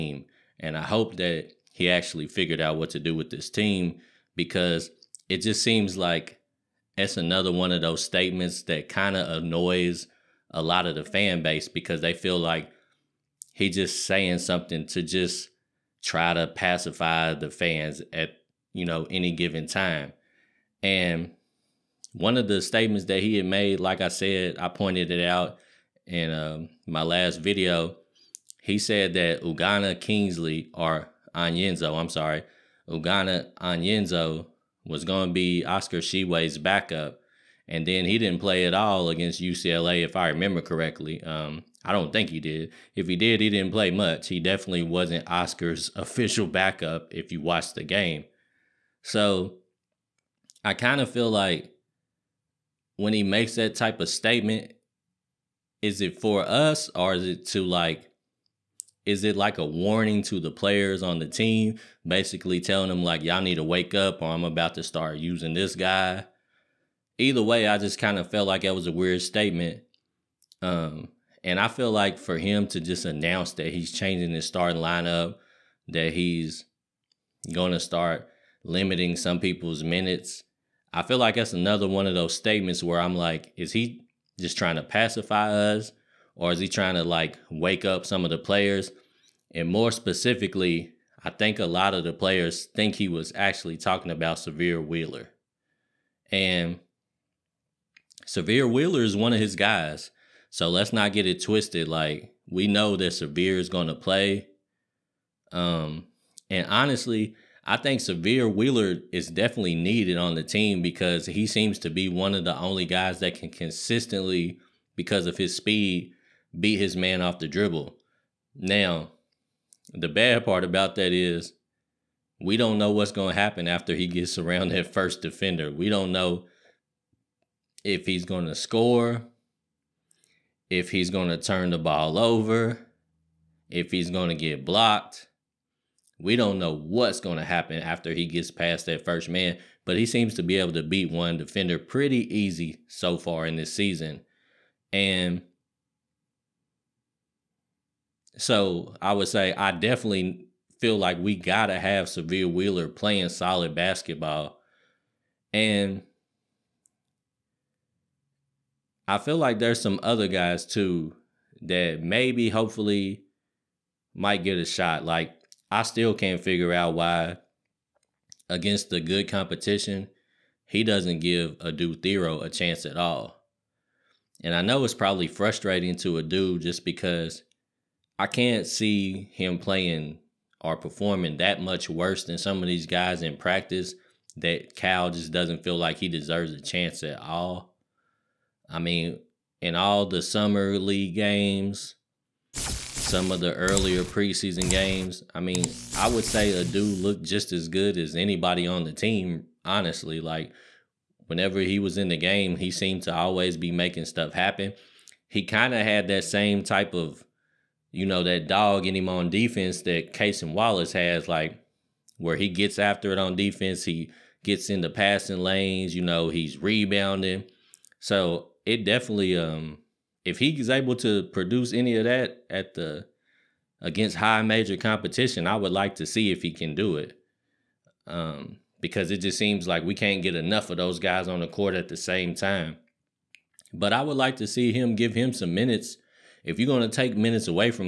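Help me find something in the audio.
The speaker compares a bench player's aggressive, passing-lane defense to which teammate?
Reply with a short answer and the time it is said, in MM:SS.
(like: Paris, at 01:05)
Cason Wallace, at 03:30.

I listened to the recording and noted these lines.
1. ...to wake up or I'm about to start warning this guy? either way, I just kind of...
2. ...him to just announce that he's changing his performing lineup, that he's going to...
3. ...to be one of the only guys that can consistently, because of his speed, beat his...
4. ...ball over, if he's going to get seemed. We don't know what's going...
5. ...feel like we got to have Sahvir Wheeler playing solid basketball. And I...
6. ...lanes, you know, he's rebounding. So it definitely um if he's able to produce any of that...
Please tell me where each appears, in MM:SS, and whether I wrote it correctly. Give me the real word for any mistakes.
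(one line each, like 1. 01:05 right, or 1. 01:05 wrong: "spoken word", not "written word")
1. 01:03 wrong: "using", not "warning"
2. 01:12 wrong: "starting", not "performing"
3. 01:51 right
4. 02:11 wrong: "blocked", not "seemed"
5. 02:30 right
6. 03:35 right.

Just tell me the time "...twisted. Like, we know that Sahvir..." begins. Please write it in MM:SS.
01:41.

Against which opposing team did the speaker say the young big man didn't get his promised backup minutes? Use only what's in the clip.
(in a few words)
UCLA.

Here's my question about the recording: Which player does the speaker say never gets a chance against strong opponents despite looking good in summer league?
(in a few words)
Adou Thiero.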